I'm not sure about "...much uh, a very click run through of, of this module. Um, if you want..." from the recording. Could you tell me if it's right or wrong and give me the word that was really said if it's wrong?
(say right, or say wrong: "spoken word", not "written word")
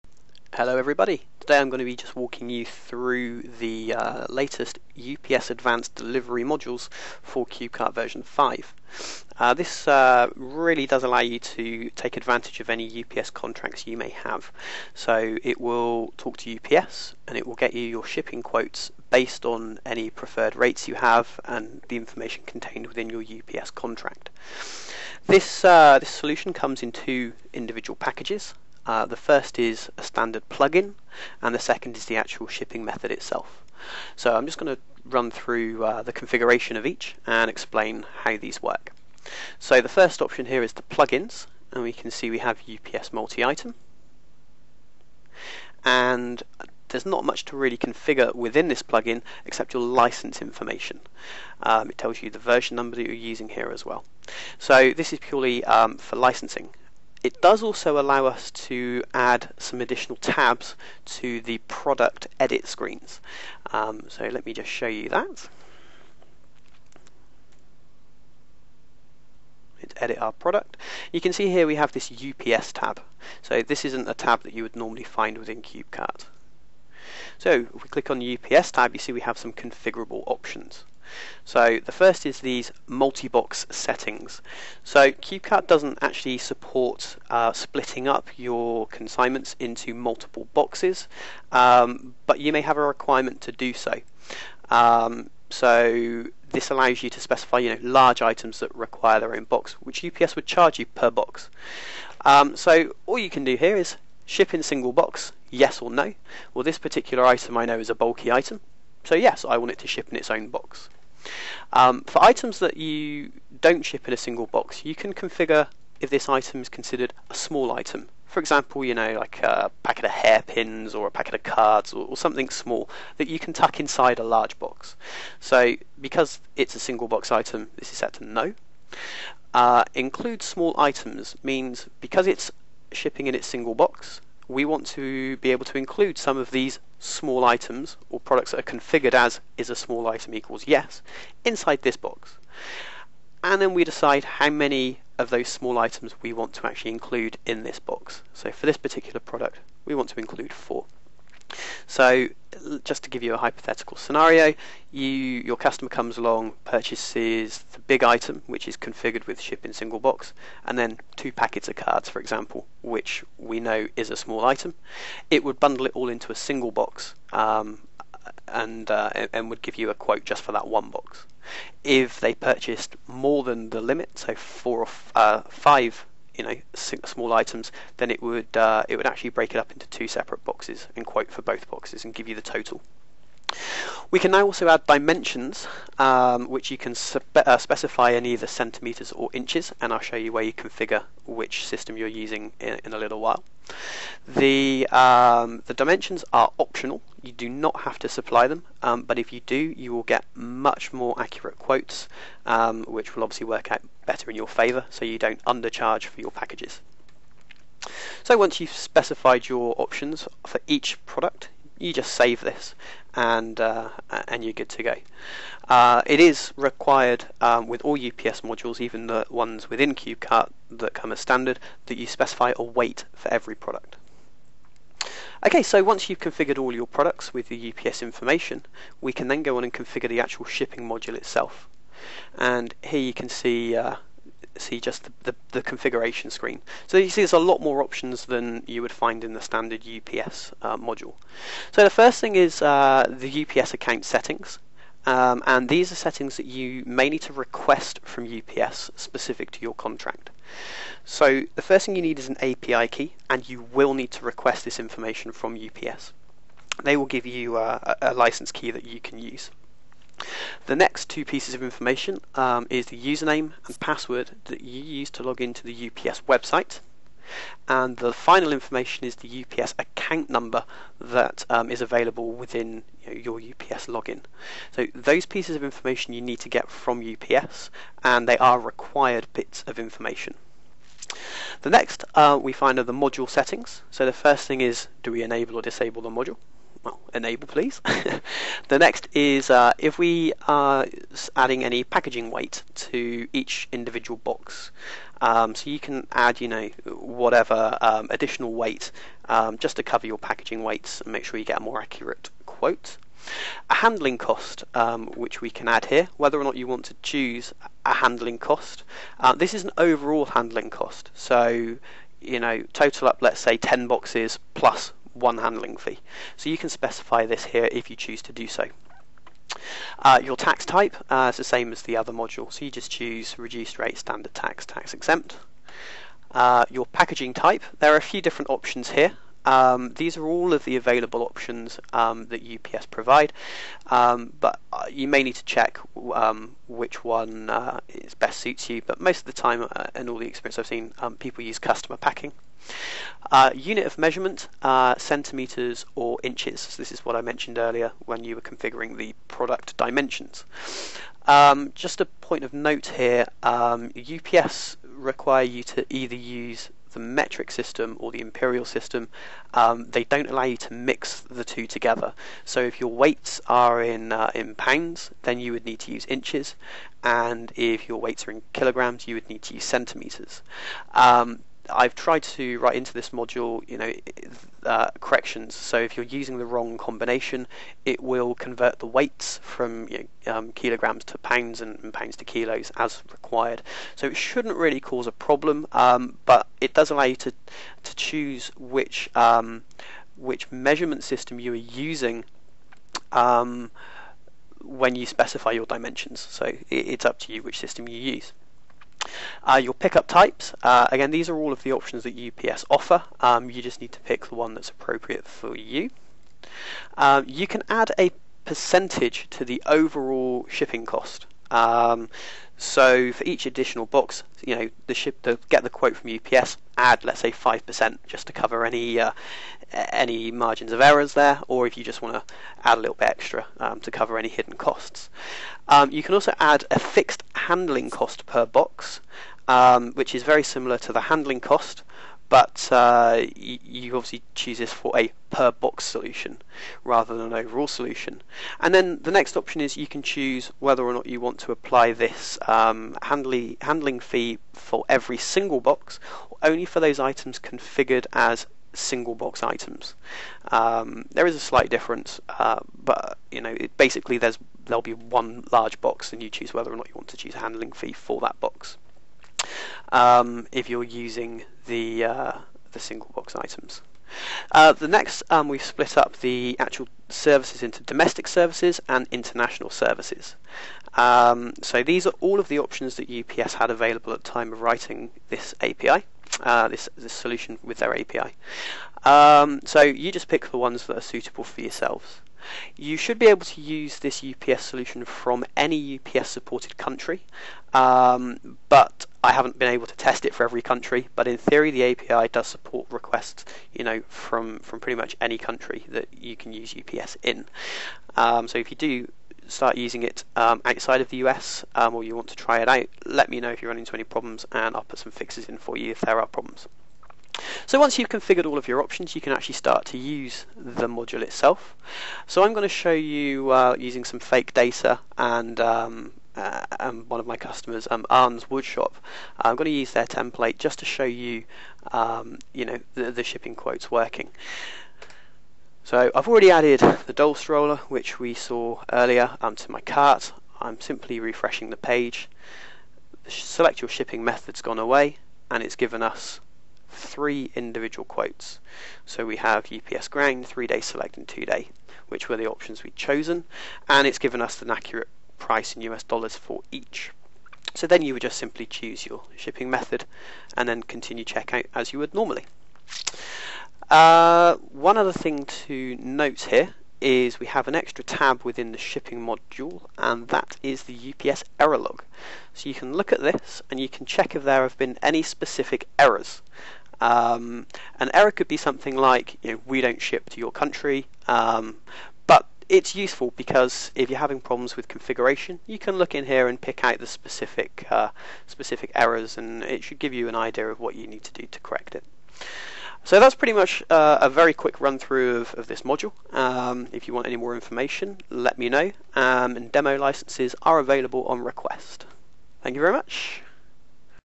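wrong: "quick", not "click".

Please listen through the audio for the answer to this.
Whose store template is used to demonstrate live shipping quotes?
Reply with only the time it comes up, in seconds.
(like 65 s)
518 s.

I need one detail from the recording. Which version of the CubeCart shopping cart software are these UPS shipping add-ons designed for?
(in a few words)
Version 5.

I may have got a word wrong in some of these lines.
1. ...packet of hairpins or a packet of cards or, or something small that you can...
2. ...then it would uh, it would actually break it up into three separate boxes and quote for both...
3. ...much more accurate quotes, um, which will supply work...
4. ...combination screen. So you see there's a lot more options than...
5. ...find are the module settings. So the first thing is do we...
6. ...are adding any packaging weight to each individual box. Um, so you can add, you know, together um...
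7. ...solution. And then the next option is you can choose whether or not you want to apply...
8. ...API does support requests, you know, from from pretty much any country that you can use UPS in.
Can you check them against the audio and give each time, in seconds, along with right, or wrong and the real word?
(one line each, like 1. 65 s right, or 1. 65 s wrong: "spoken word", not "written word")
1. 119 s right
2. 177 s wrong: "two", not "three"
3. 200 s wrong: "obviously", not "supply"
4. 235 s wrong: "configuration", not "combination"
5. 282 s right
6. 290 s wrong: "whatever", not "together"
7. 437 s right
8. 491 s right.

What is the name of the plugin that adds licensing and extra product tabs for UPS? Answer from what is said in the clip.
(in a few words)
UPS multi-item.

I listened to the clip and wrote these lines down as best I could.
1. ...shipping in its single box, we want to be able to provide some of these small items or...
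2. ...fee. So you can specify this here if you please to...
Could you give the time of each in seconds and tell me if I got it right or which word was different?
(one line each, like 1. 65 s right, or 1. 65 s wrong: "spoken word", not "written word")
1. 132 s wrong: "include", not "provide"
2. 315 s wrong: "choose", not "please".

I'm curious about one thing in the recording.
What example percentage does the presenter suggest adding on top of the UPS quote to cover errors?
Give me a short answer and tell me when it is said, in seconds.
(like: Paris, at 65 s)
5 percent, at 417 s.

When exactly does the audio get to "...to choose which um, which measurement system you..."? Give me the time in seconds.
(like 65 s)
387 s.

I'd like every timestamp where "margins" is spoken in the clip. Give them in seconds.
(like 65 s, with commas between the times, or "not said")
420 s.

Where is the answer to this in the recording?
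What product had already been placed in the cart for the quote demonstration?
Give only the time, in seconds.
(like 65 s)
527 s.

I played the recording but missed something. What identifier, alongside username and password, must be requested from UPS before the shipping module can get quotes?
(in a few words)
API key.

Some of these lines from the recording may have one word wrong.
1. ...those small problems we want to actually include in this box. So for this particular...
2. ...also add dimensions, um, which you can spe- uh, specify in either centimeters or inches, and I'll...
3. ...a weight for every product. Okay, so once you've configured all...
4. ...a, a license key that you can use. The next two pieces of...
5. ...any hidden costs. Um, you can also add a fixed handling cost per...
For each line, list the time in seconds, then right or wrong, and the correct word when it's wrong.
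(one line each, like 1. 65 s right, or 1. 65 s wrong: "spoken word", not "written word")
1. 145 s wrong: "items", not "problems"
2. 184 s right
3. 222 s right
4. 258 s right
5. 424 s right.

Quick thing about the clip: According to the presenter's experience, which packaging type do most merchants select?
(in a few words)
Customer packing.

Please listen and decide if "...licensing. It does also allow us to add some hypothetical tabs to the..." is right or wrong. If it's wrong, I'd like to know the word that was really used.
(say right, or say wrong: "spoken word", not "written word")
wrong: "additional", not "hypothetical".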